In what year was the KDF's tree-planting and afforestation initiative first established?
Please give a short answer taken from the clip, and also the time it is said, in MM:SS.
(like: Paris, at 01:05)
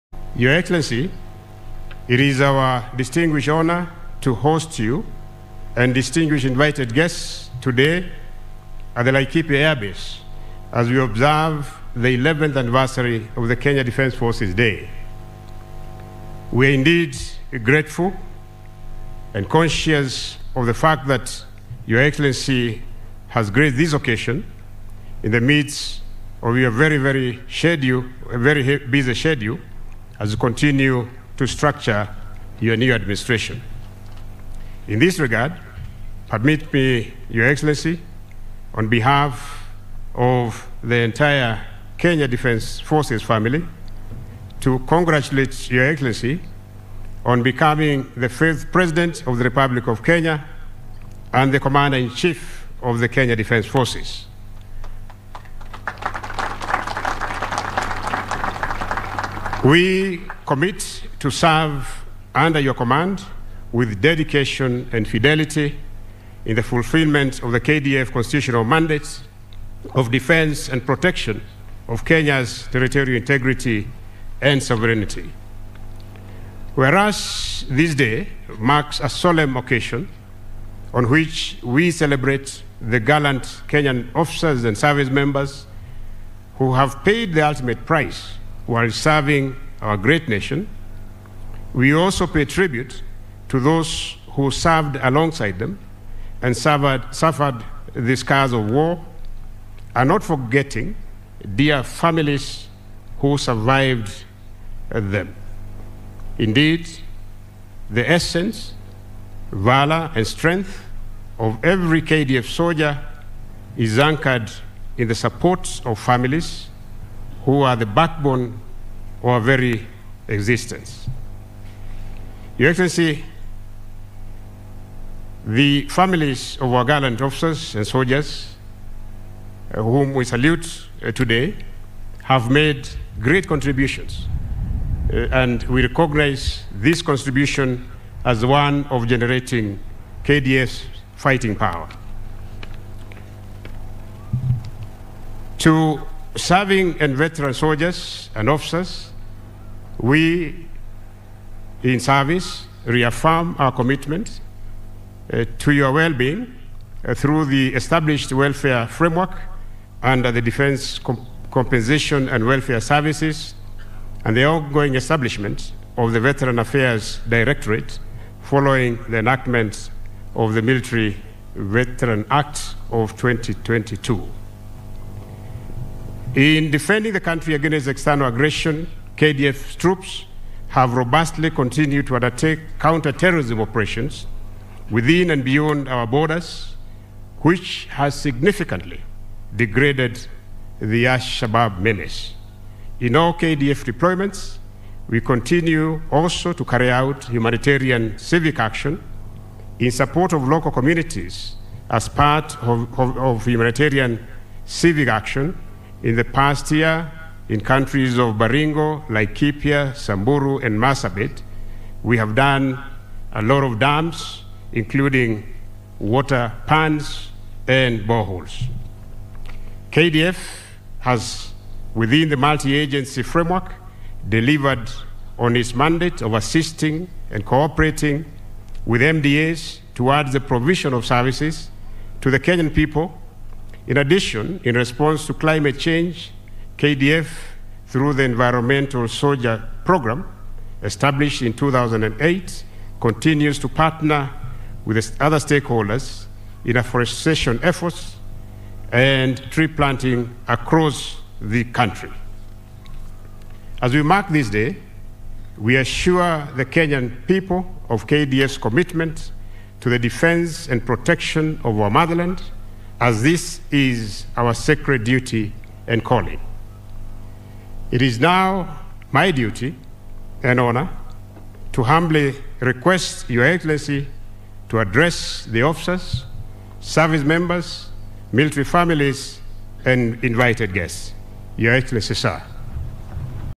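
2008, at 04:01.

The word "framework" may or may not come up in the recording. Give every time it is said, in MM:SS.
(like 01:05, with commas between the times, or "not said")
02:38, 03:43.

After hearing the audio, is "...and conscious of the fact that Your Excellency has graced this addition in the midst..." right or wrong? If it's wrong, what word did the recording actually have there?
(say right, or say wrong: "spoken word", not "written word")
wrong: "occasion", not "addition".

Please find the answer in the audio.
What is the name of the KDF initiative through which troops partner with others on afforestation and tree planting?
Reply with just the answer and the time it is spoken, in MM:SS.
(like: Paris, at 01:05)
Environmental Soldier Program, at 03:58.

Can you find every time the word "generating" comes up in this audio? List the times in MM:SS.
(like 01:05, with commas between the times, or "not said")
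02:19.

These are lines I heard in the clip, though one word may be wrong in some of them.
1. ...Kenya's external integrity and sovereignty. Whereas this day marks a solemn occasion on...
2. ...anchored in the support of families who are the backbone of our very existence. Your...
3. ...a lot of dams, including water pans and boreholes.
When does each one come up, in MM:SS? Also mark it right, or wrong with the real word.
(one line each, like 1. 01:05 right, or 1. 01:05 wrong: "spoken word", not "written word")
1. 01:12 wrong: "territorial", not "external"
2. 01:53 right
3. 03:33 right.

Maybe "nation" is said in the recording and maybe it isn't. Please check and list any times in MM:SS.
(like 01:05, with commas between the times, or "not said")
01:30.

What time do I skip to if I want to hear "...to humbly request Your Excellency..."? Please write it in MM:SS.
04:31.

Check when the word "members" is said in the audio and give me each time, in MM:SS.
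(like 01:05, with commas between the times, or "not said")
01:25, 04:37.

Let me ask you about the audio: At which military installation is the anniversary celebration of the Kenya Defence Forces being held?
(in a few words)
Laikipia Air Base.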